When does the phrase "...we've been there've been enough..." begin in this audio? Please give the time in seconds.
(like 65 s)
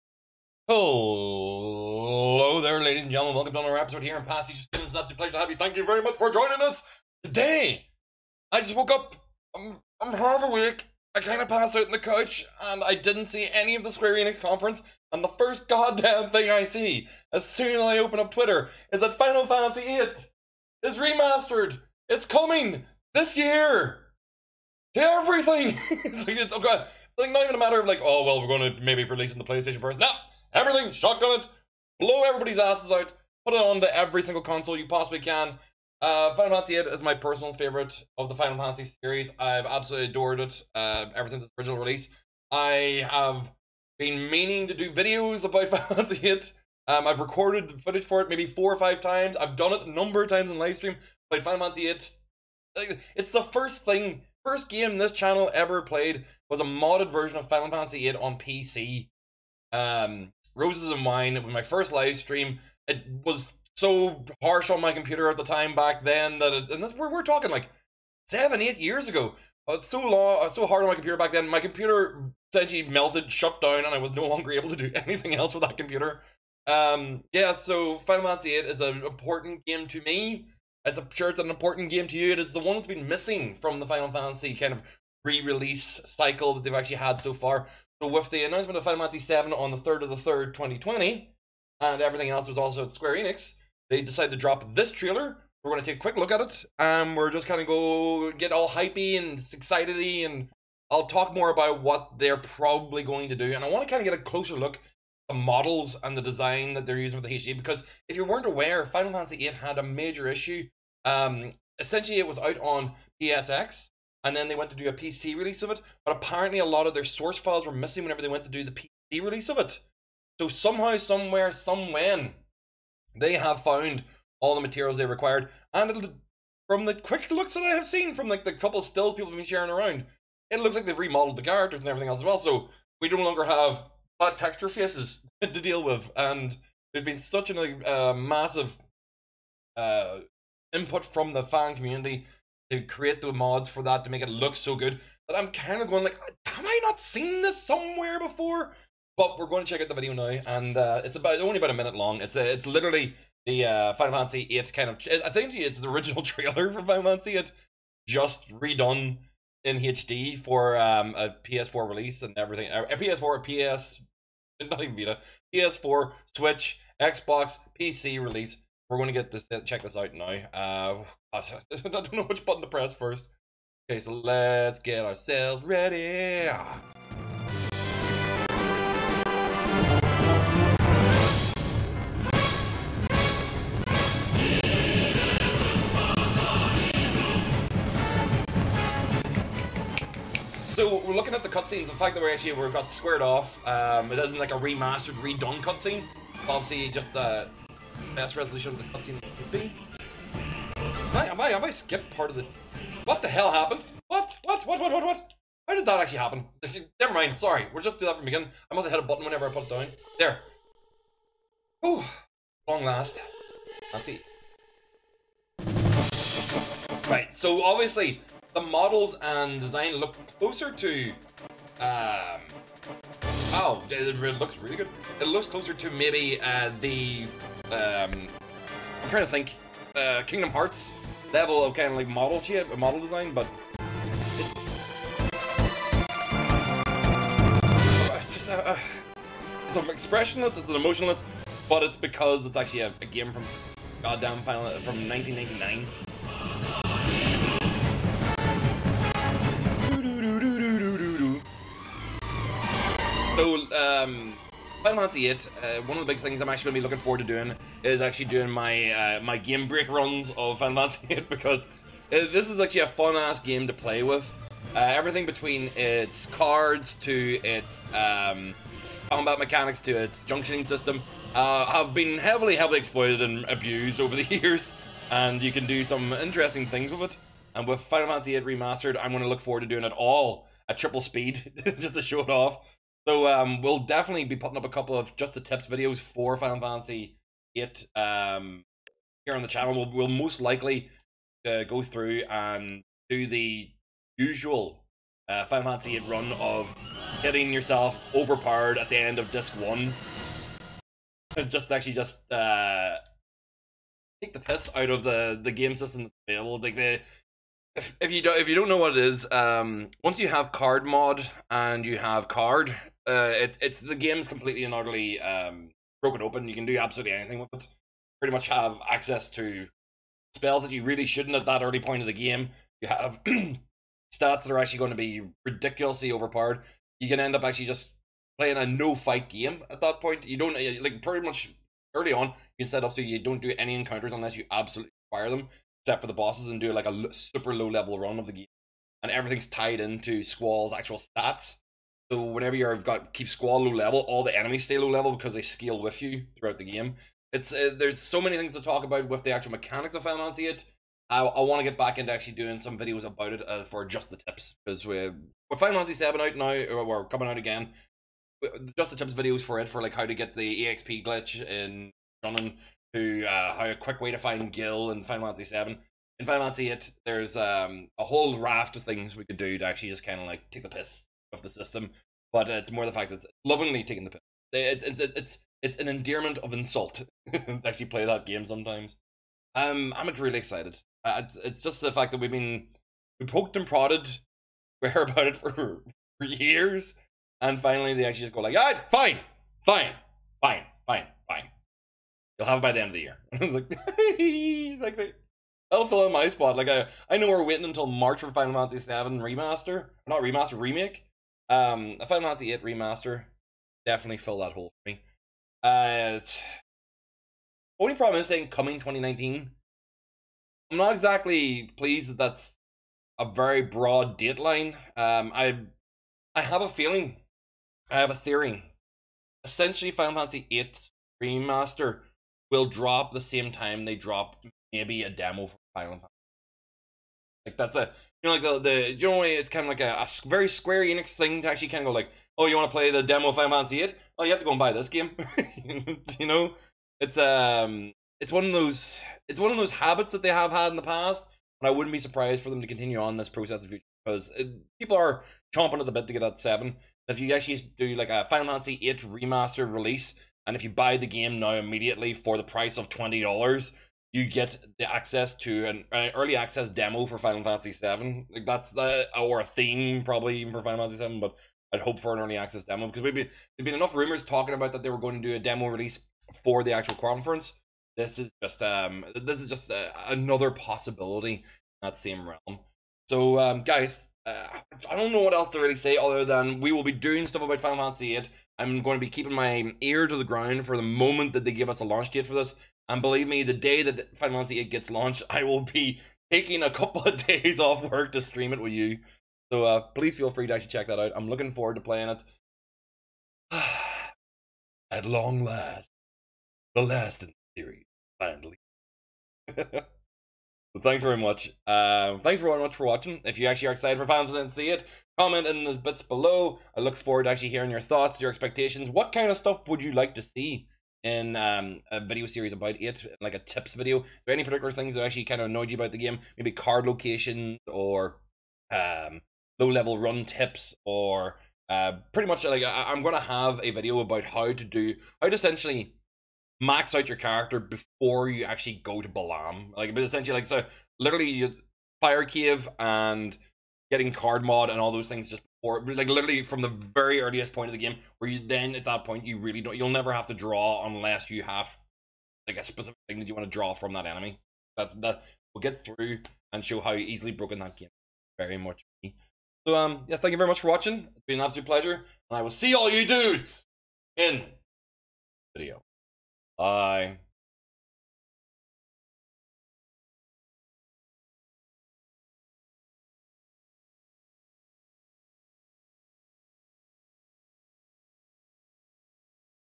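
463 s.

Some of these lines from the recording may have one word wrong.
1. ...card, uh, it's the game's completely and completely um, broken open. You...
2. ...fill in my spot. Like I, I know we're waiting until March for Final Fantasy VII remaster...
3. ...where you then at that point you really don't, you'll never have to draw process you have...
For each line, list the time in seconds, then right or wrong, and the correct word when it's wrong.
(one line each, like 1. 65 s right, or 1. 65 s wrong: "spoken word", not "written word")
1. 312 s wrong: "utterly", not "completely"
2. 395 s right
3. 538 s wrong: "unless", not "process".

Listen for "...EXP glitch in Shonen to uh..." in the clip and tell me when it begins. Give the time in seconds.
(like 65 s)
360 s.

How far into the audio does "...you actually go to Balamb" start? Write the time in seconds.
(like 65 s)
528 s.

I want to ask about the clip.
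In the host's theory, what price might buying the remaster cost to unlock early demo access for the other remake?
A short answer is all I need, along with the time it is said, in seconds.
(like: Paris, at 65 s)
$20, at 452 s.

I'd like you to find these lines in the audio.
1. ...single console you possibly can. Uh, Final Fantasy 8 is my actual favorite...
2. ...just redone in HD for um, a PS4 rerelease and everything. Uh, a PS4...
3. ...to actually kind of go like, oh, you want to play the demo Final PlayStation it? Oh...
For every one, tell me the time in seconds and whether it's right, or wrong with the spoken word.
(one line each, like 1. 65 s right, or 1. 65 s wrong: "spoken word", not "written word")
1. 34 s wrong: "personal", not "actual"
2. 158 s wrong: "release", not "rerelease"
3. 431 s wrong: "Fantasy", not "PlayStation".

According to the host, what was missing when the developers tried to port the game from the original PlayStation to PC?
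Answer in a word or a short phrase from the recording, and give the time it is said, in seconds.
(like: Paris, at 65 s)
source files, at 117 s.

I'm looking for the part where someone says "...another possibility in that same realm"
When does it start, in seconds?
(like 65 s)
470 s.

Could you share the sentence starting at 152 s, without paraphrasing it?
It's a, uh, it's literally the uh, Final Fantasy VIII kind of.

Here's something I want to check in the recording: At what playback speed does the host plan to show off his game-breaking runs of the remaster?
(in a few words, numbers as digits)
triple speed.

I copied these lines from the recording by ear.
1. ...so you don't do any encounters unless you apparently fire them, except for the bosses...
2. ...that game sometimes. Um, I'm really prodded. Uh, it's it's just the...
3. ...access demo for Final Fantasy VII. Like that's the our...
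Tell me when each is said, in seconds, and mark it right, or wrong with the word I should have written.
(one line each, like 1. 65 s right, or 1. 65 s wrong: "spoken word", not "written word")
1. 332 s wrong: "absolutely", not "apparently"
2. 378 s wrong: "excited", not "prodded"
3. 456 s right.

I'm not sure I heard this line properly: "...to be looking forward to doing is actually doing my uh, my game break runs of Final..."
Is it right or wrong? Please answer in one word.
right.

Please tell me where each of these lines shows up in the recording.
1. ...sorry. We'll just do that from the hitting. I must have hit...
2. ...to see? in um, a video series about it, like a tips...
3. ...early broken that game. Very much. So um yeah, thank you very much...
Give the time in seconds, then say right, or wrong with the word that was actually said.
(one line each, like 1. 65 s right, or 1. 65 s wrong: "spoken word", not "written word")
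1. 207 s wrong: "beginning", not "hitting"
2. 510 s right
3. 546 s wrong: "easily", not "early".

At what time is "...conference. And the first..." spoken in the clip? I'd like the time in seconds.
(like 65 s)
14 s.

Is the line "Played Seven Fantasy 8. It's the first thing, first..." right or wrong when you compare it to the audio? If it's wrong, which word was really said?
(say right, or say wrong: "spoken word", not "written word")
wrong: "Final", not "Seven".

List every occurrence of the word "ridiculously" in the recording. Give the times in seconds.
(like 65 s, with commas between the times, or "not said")
325 s.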